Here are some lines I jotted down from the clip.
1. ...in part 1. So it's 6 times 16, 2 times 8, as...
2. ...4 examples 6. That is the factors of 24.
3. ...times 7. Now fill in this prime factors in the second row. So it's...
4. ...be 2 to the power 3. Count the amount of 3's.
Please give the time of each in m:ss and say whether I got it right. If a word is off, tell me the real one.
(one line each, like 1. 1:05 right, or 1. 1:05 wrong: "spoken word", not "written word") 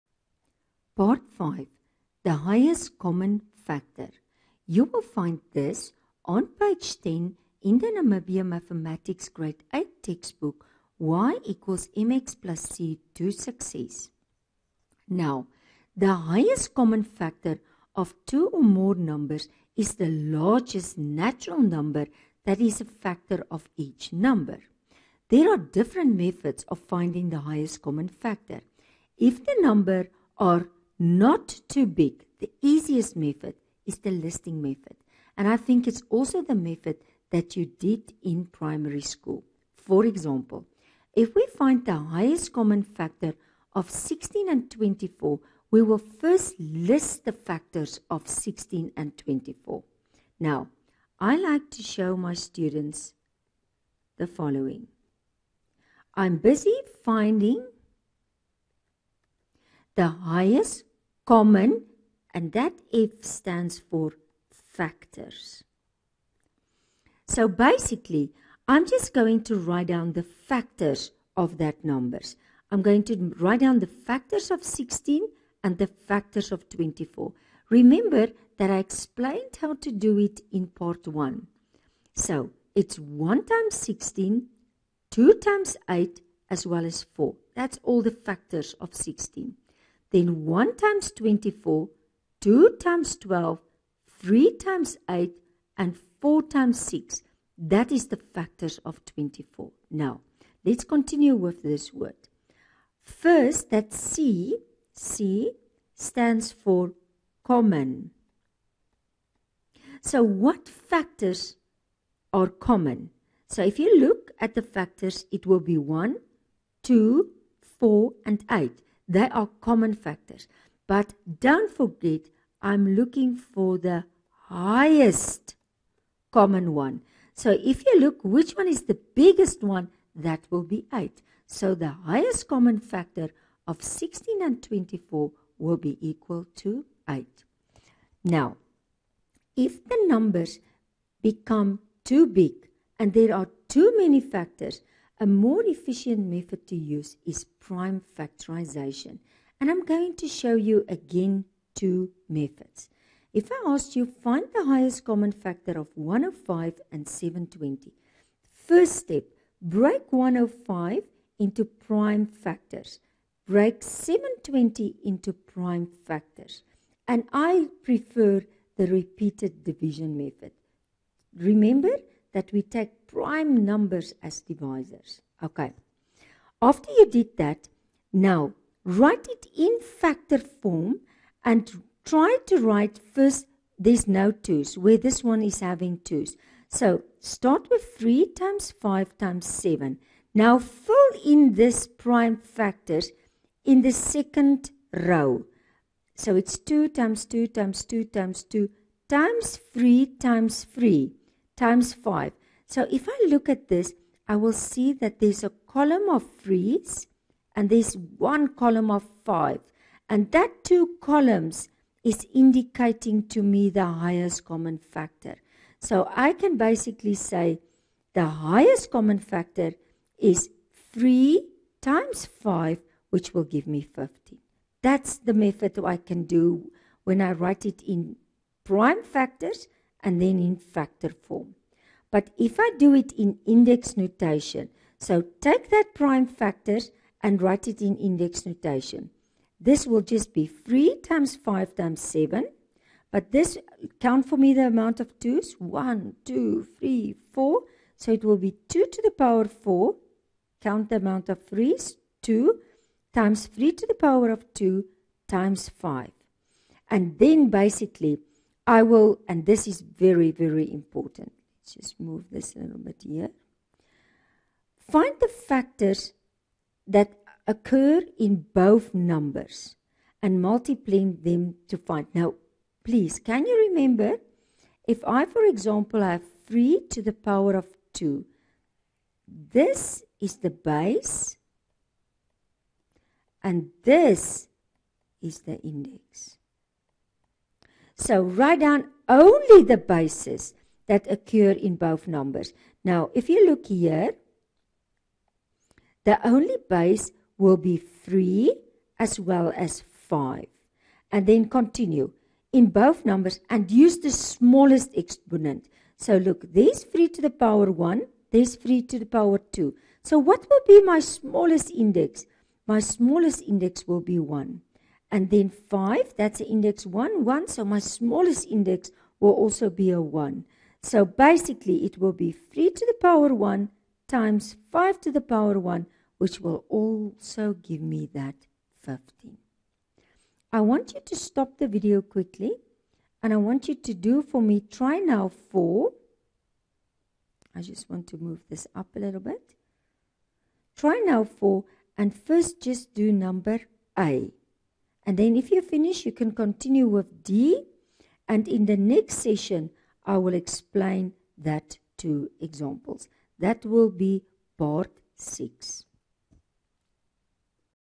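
1. 1:20 wrong: "1", not "6"
2. 1:36 wrong: "times", not "examples"
3. 3:09 right
4. 4:08 wrong: "4", not "3".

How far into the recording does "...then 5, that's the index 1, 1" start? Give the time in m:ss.
5:15.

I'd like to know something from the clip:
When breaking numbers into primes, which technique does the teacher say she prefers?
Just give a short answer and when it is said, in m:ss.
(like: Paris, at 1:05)
repeated division method, at 2:48.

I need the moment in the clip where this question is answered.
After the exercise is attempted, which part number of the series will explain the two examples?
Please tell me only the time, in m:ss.
5:54.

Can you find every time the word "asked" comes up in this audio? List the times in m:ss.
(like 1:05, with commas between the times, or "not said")
2:33.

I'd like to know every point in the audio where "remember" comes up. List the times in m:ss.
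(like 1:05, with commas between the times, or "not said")
1:17, 2:51, 4:33.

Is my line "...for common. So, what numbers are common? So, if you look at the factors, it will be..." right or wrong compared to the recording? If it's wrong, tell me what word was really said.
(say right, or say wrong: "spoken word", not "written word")
wrong: "factors", not "numbers".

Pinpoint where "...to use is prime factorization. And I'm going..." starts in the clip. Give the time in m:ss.
2:26.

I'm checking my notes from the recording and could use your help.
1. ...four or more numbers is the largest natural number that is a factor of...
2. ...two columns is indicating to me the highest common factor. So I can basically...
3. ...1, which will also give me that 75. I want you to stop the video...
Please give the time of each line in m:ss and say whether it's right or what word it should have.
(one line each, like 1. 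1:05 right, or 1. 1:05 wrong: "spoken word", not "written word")
1. 0:18 wrong: "two", not "four"
2. 3:30 right
3. 5:25 wrong: "15", not "75".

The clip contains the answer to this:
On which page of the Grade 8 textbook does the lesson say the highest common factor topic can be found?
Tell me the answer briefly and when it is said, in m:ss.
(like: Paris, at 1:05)
10, at 0:06.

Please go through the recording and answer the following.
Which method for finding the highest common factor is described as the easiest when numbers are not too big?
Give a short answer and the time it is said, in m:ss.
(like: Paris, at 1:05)
listing method, at 0:34.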